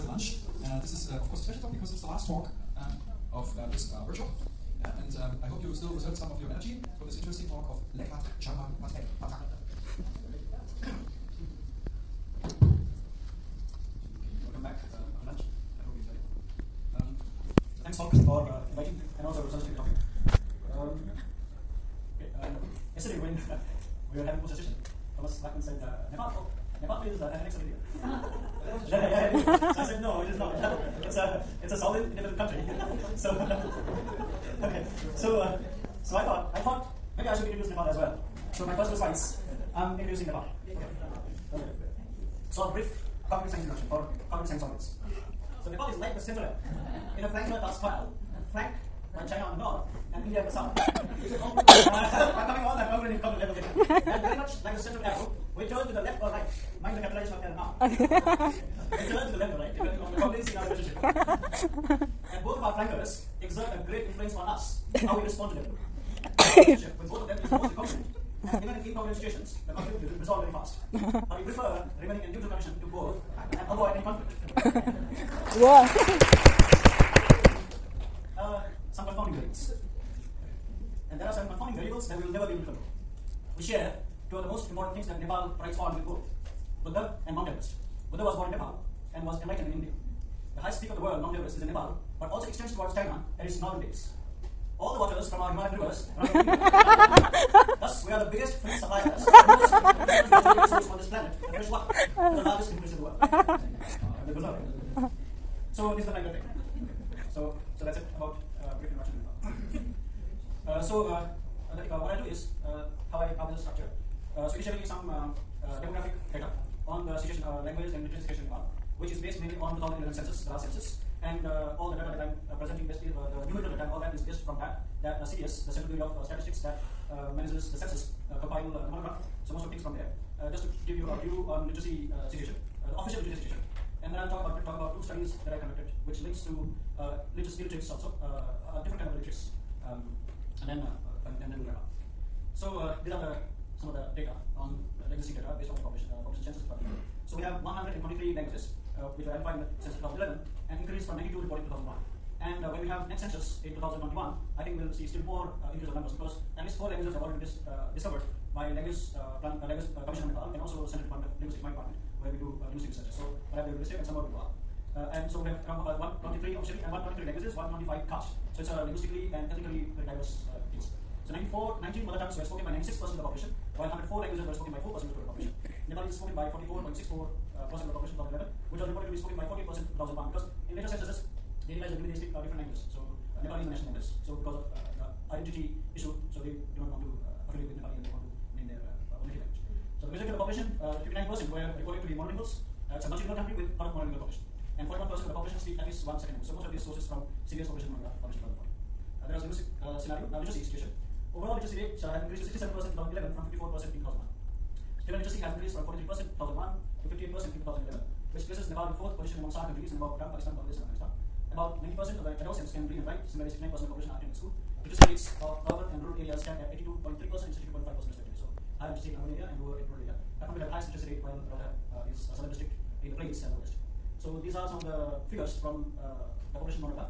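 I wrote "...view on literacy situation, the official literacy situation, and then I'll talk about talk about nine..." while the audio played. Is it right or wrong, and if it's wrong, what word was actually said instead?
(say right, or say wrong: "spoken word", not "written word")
wrong: "two", not "nine".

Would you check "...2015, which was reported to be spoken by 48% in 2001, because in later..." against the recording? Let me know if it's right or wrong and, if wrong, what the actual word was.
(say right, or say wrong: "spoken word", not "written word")
wrong: "2011", not "2015".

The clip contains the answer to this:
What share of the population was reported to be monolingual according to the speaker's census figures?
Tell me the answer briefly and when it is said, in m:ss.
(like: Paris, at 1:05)
59%, at 3:11.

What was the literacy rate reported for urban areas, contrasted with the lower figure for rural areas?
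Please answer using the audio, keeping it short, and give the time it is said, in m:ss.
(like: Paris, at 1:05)
82.3%, at 3:36.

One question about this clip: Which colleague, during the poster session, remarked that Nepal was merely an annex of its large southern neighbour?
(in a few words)
Thomas Lachmann.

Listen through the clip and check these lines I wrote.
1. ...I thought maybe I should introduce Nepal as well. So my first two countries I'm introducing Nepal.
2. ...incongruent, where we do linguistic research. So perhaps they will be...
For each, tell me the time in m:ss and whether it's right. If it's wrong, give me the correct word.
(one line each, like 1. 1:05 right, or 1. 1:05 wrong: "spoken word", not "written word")
1. 0:36 wrong: "slides", not "countries"
2. 2:41 wrong: "department", not "incongruent".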